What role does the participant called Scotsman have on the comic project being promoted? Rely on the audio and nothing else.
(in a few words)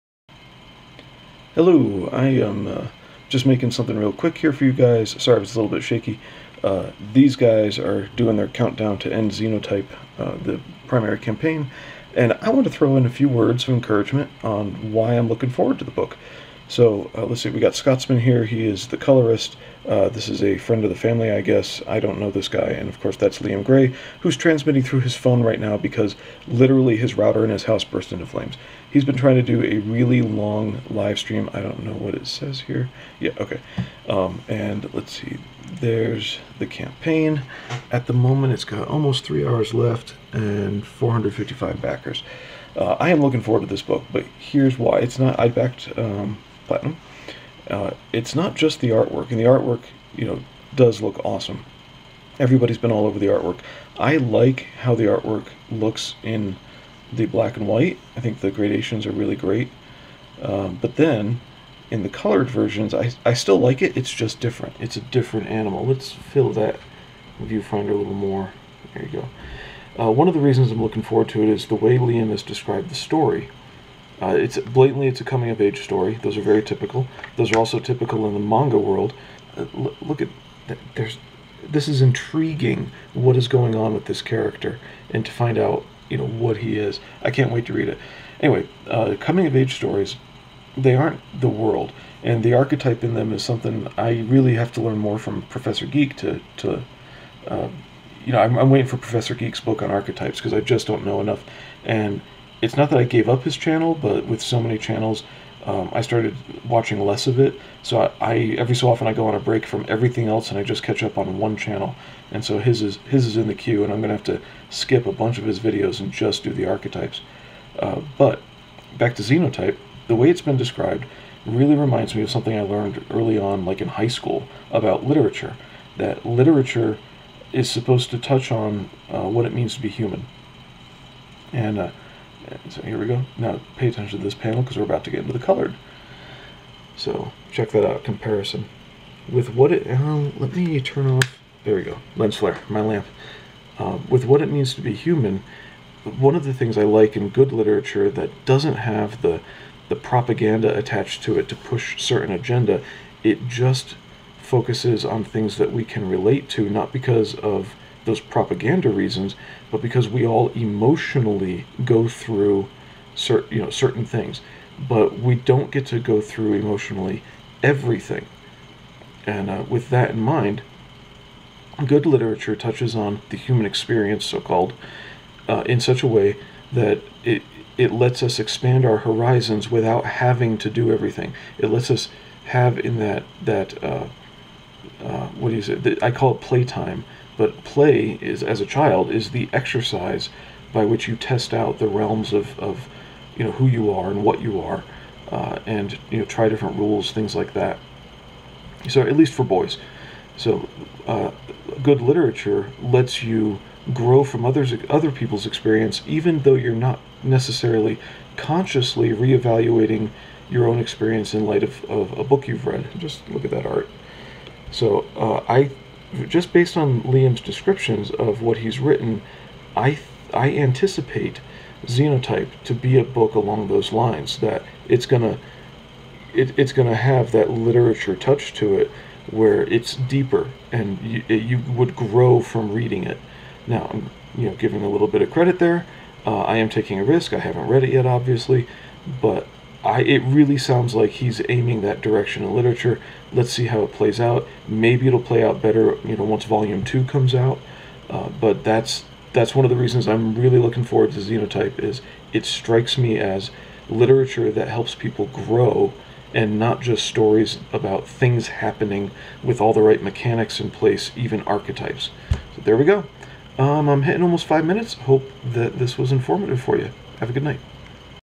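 Colorist.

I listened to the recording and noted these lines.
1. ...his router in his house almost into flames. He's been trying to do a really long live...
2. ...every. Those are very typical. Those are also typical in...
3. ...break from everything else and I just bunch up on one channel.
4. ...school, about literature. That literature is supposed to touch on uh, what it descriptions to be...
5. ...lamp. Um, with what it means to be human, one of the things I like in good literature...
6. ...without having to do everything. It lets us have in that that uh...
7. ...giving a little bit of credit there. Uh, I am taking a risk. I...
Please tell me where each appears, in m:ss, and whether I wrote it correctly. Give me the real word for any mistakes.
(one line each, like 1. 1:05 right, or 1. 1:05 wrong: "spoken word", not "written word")
1. 0:26 wrong: "burst", not "almost"
2. 1:15 wrong: "story", not "every"
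3. 1:49 wrong: "catch", not "bunch"
4. 2:04 wrong: "means", not "descriptions"
5. 2:22 right
6. 2:59 right
7. 3:54 right.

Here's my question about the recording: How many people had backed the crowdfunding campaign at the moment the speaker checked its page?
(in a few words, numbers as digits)
455.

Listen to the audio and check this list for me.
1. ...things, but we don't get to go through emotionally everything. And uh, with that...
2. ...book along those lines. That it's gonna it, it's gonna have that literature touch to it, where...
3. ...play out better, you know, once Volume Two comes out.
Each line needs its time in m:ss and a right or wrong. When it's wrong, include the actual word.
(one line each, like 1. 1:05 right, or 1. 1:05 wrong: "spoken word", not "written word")
1. 2:44 right
2. 3:43 right
3. 4:05 right.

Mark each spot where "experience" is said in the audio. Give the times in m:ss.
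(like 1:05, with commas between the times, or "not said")
2:53, 3:25, 3:30.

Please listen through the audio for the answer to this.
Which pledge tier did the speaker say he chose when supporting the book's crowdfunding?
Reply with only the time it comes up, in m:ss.
0:46.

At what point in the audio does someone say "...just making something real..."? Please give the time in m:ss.
0:03.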